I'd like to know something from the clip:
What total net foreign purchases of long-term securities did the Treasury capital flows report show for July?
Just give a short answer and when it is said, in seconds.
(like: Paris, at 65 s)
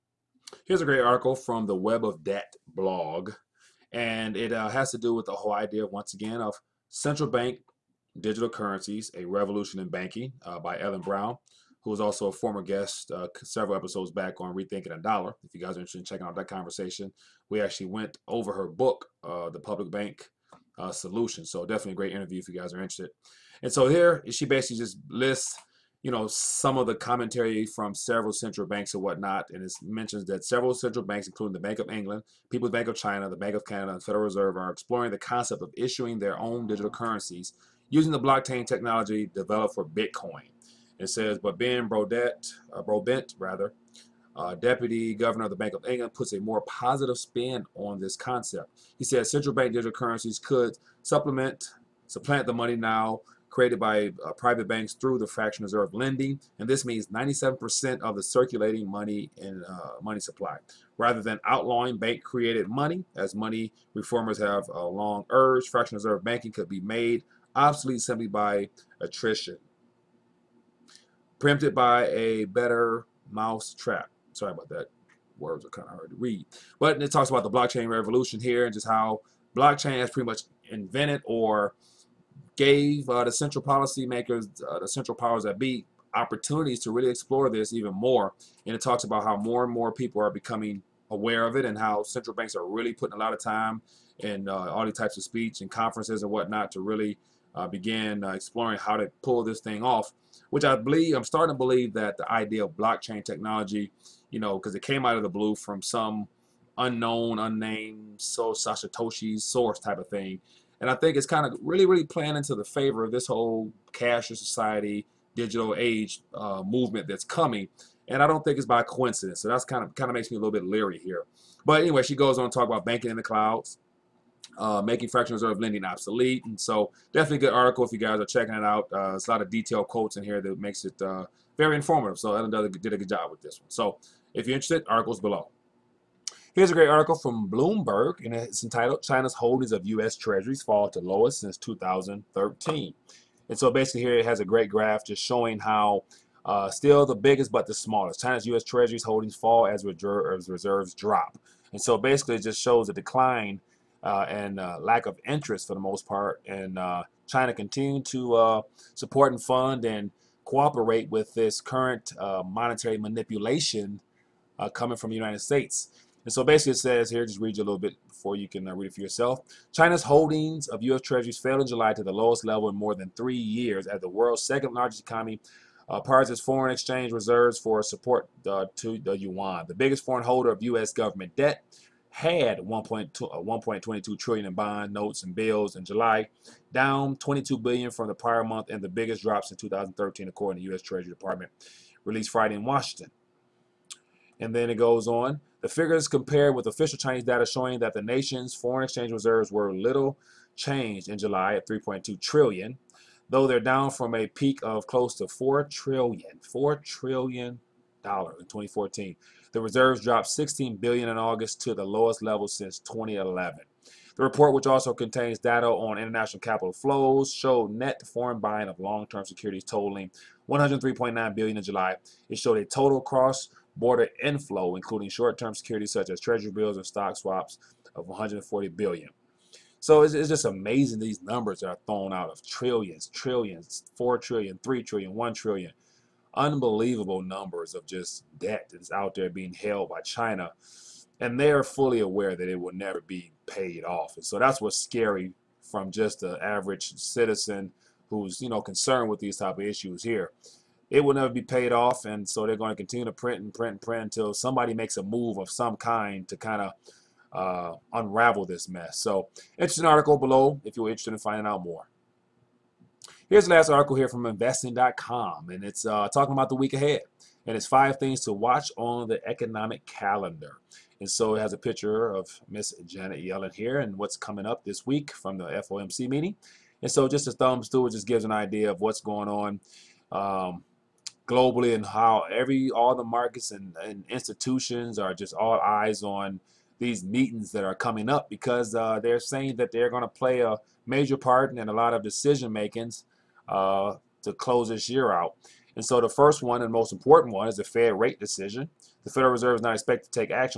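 103.9 billion, at 220 s.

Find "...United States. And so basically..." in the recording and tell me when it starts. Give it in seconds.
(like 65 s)
165 s.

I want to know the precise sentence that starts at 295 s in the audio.
And so the first one and most important one is the Fed rate decision.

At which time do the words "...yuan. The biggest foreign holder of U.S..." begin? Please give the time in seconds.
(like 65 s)
179 s.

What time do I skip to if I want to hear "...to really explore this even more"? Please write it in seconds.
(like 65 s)
86 s.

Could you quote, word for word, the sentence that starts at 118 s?
And I don't think it's by coincidence.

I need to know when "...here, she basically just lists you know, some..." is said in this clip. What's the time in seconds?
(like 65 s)
23 s.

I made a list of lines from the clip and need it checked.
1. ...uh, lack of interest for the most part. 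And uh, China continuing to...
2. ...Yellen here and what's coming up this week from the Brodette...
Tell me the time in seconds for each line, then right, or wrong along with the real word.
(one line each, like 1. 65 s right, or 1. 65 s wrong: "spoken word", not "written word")
1. 154 s right
2. 273 s wrong: "FOMC", not "Brodette".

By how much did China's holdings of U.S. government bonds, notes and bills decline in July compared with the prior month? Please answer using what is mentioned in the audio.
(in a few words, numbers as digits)
22 billion.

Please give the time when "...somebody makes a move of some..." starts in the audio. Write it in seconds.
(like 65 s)
254 s.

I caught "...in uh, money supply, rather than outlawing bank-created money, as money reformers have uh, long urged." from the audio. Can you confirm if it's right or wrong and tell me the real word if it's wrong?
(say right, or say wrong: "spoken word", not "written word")
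right.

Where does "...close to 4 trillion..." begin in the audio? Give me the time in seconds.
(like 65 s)
204 s.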